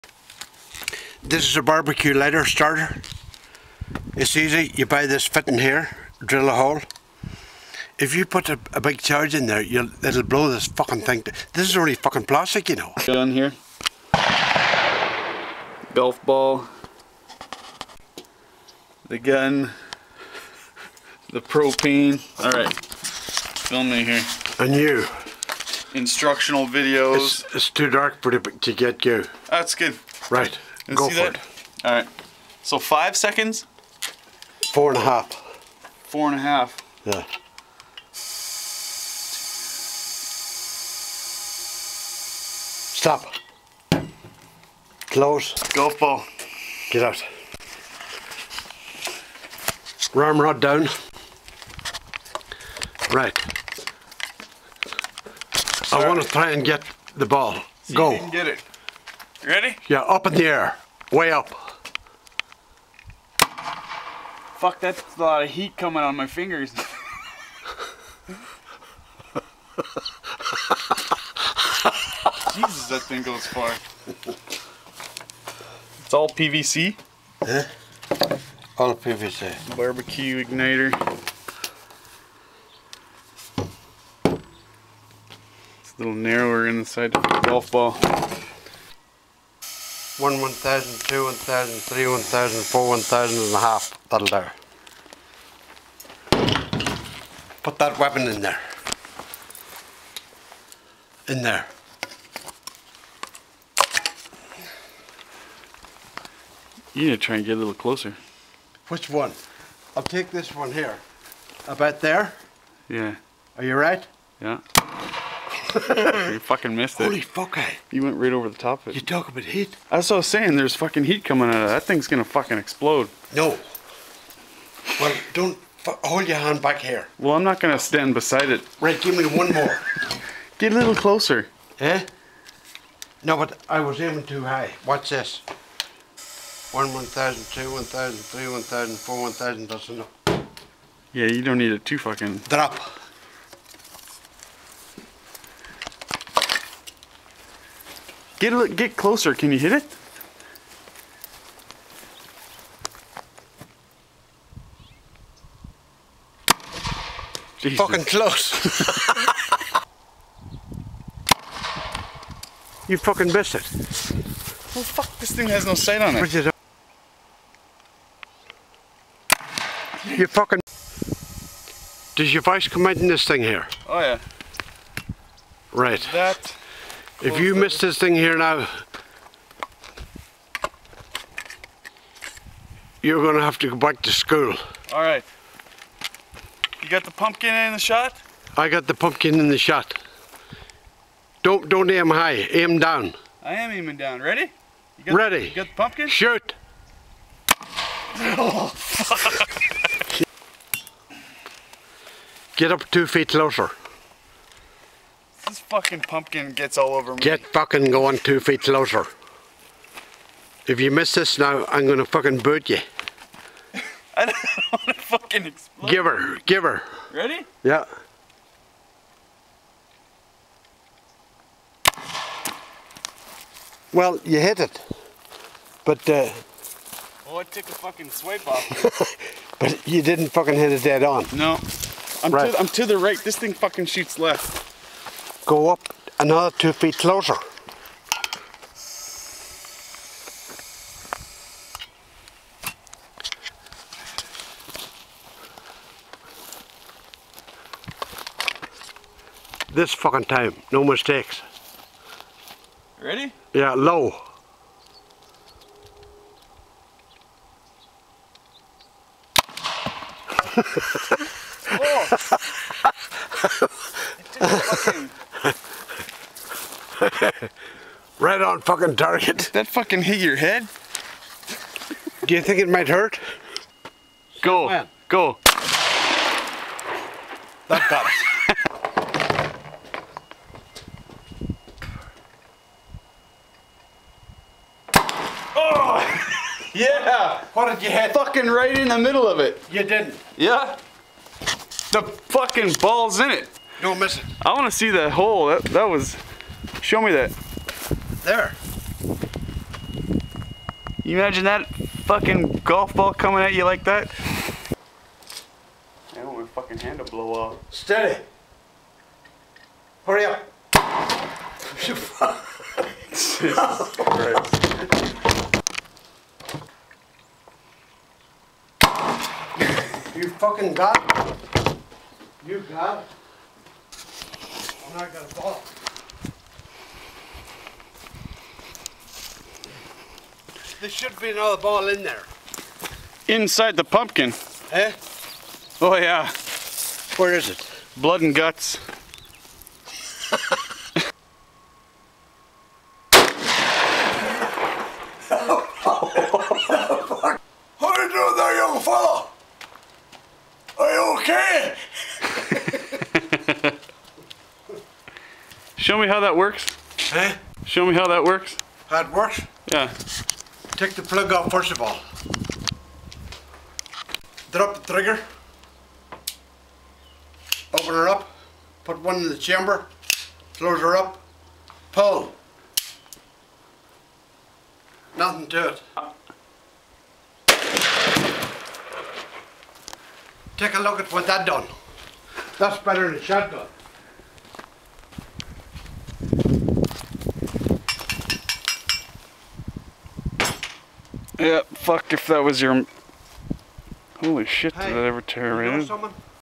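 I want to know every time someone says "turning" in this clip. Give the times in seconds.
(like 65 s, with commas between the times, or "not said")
not said.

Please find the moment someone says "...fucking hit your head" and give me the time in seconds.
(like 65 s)
269 s.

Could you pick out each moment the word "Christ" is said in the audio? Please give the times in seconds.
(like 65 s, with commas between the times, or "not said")
313 s.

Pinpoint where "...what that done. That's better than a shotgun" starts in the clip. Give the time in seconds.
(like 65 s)
381 s.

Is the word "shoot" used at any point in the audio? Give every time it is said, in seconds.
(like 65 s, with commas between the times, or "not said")
196 s, 233 s.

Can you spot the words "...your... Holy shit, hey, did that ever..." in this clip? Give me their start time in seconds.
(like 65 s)
392 s.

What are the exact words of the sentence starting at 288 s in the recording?
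Fucking right in the middle of it.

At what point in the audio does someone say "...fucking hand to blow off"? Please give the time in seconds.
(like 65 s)
306 s.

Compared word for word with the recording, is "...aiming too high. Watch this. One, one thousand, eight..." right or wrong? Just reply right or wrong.
wrong.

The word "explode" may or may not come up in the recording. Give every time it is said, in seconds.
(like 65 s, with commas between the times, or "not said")
122 s, 215 s.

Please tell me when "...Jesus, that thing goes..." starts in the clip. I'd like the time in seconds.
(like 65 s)
72 s.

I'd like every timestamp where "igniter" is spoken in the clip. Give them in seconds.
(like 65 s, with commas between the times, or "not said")
80 s.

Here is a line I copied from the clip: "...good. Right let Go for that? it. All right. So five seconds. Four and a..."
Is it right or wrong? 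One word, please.
right.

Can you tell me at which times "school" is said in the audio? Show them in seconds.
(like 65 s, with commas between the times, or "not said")
184 s.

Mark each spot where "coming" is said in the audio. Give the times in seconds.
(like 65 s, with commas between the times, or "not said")
65 s, 121 s, 303 s.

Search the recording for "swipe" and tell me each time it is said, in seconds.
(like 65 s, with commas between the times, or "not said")
228 s.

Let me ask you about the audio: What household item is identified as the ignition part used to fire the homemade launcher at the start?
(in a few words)
barbecue lighter starter.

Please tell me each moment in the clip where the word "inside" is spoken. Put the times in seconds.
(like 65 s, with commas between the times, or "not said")
86 s, 333 s.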